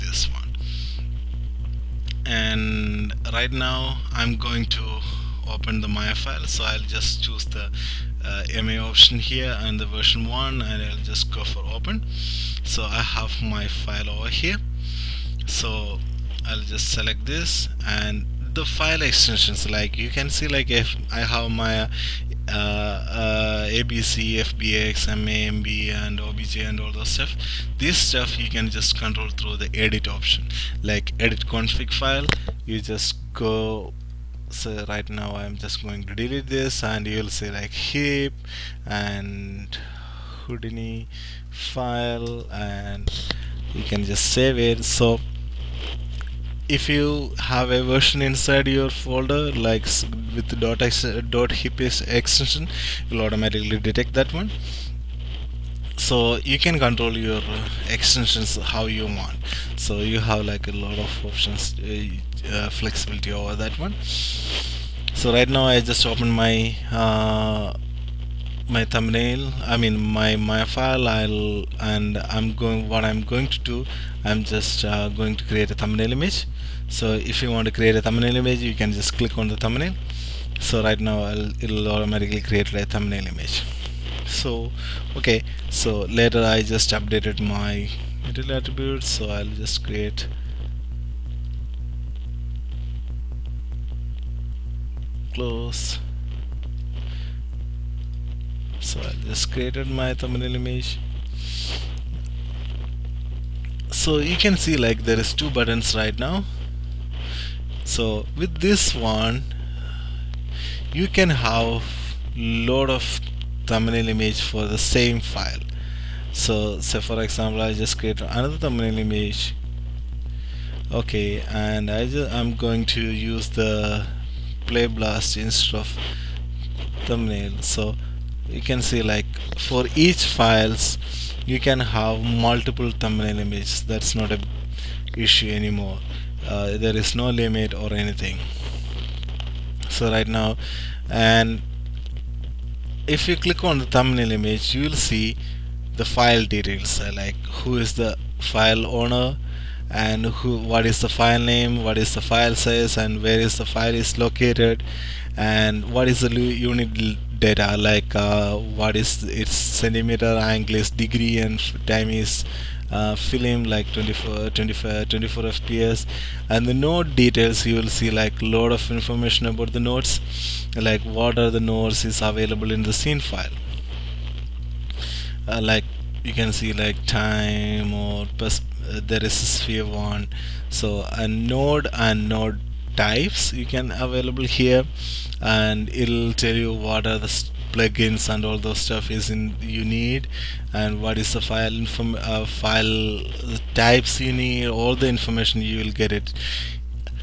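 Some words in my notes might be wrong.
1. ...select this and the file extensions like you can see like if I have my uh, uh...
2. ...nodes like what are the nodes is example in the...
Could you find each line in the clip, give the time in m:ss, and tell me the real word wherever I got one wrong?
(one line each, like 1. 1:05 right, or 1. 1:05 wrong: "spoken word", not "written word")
1. 0:16 right
2. 2:49 wrong: "available", not "example".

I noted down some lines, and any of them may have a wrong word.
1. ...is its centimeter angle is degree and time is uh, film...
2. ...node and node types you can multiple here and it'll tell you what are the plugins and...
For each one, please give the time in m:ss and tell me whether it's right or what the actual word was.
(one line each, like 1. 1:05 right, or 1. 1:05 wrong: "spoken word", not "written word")
1. 2:38 right
2. 3:01 wrong: "available", not "multiple".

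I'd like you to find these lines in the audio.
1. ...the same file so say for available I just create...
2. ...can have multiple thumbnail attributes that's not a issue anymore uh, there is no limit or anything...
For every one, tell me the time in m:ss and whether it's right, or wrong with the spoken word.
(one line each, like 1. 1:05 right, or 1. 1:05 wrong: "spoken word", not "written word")
1. 1:54 wrong: "example", not "available"
2. 2:11 wrong: "images", not "attributes".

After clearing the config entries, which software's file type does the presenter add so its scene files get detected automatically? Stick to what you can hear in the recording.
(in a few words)
Houdini.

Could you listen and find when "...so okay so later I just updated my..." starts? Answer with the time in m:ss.
1:24.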